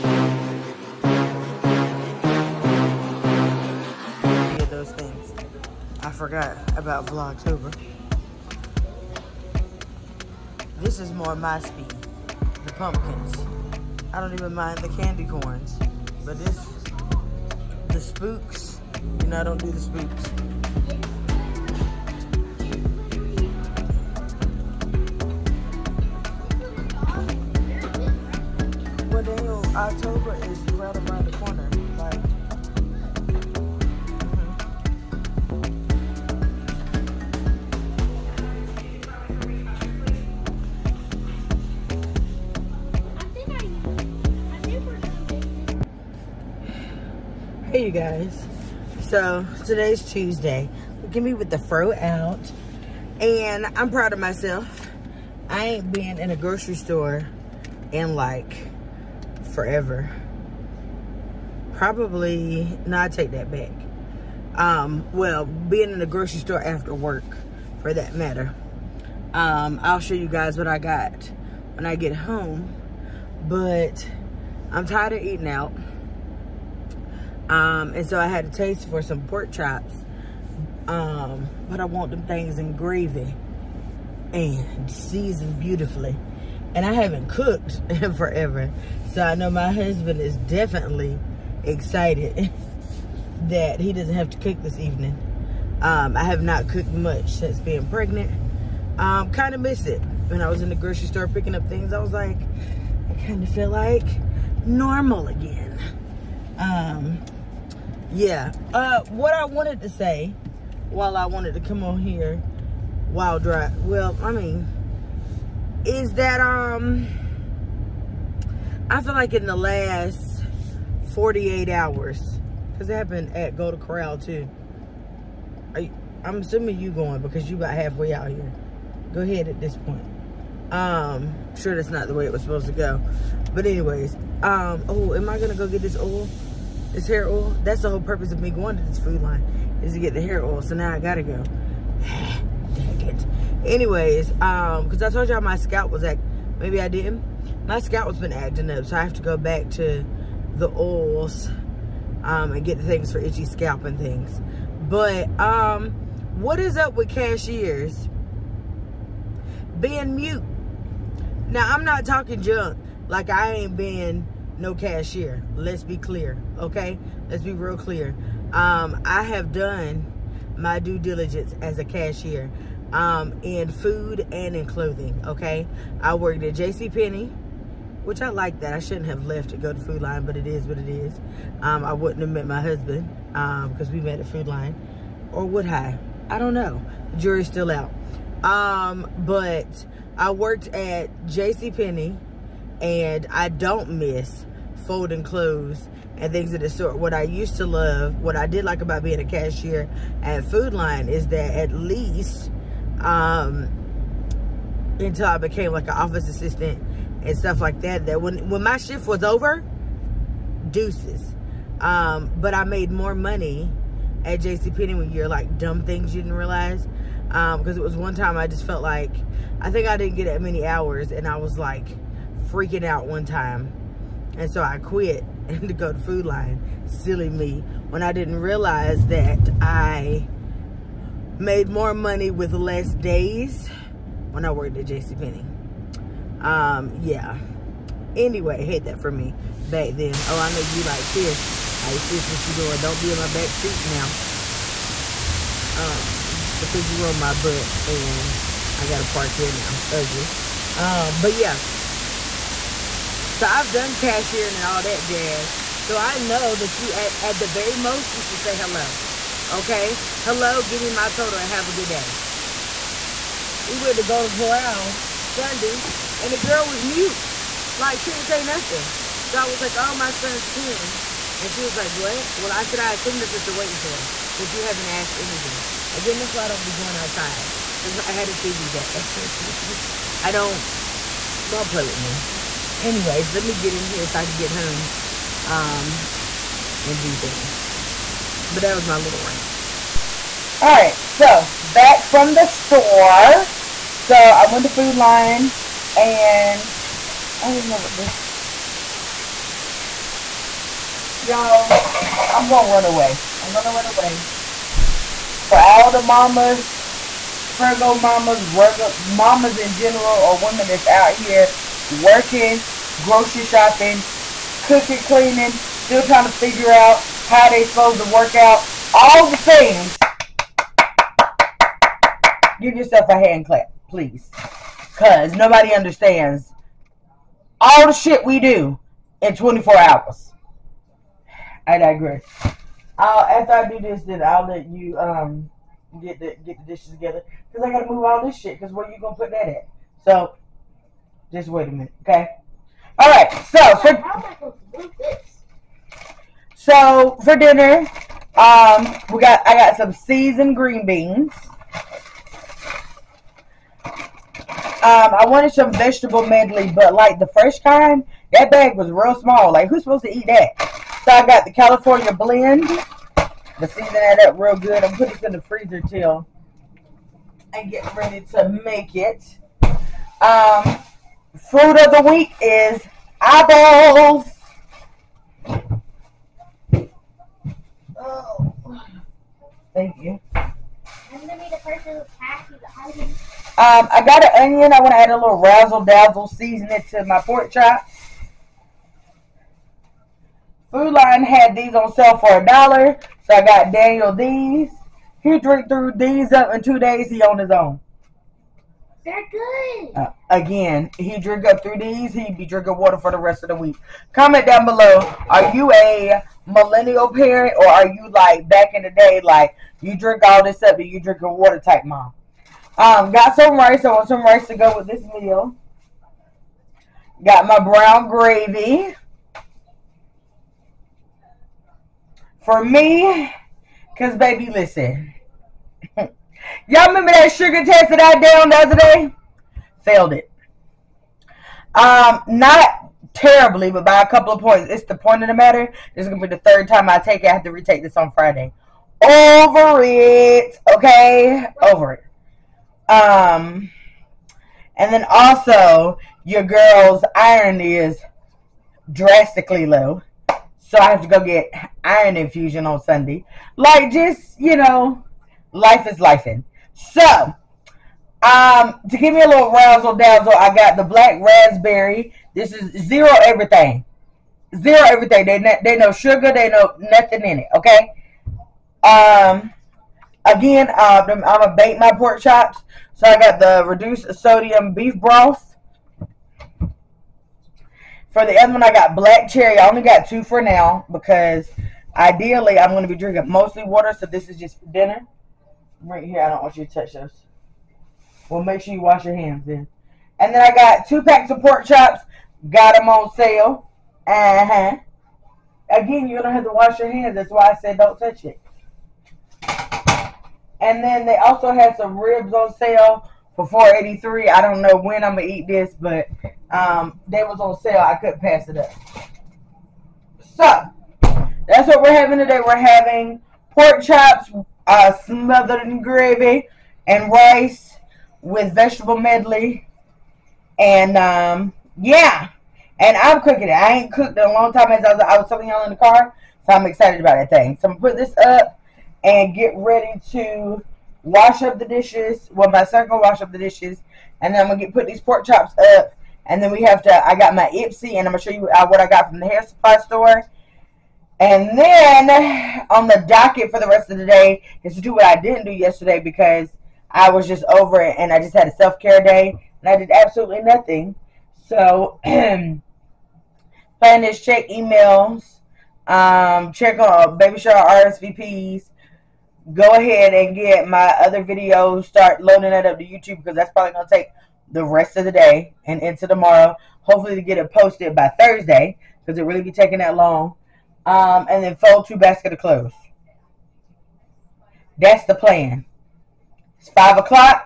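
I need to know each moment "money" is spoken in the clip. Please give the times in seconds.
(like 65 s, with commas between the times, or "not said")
213 s, 231 s.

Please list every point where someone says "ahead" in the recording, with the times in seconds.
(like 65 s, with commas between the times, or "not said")
129 s, 559 s.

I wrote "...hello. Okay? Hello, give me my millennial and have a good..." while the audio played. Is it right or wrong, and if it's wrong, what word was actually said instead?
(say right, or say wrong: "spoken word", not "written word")
wrong: "total", not "millennial".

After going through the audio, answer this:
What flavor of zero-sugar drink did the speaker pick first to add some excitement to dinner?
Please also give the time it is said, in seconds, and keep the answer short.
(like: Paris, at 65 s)
black raspberry, at 460 s.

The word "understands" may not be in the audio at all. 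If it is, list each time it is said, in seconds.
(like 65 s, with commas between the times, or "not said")
325 s.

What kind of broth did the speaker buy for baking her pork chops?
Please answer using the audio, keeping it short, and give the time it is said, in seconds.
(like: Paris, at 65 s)
reduced sodium beef broth, at 473 s.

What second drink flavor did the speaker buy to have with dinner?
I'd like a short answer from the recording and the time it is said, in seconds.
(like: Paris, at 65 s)
black cherry, at 478 s.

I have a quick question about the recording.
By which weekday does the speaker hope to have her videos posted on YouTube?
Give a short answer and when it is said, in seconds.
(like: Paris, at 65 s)
Thursday, at 568 s.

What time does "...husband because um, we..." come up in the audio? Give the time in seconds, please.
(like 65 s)
182 s.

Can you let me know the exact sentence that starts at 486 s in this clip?
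I don't want you to touch those.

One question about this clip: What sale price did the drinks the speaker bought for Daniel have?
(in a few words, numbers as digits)
a dollar.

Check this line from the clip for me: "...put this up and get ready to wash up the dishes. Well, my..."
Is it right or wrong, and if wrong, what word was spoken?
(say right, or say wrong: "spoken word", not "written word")
right.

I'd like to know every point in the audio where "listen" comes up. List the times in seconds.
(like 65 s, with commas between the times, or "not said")
424 s.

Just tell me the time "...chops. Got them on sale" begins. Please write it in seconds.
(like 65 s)
491 s.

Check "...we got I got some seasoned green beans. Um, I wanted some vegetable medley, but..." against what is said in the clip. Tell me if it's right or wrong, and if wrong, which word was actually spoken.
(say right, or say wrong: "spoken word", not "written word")
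right.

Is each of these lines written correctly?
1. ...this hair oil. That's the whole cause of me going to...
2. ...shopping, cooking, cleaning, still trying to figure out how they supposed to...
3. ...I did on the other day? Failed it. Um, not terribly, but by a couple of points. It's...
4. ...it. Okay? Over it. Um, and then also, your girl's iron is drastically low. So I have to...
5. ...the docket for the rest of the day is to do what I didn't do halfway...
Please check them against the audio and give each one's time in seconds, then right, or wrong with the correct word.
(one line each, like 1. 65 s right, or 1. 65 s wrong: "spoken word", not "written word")
1. 136 s wrong: "purpose", not "cause"
2. 313 s right
3. 427 s right
4. 439 s right
5. 542 s wrong: "yesterday", not "halfway".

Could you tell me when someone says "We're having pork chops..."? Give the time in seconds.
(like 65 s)
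512 s.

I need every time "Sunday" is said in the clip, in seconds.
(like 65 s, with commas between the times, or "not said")
265 s, 452 s.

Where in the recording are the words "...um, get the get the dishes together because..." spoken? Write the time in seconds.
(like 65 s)
334 s.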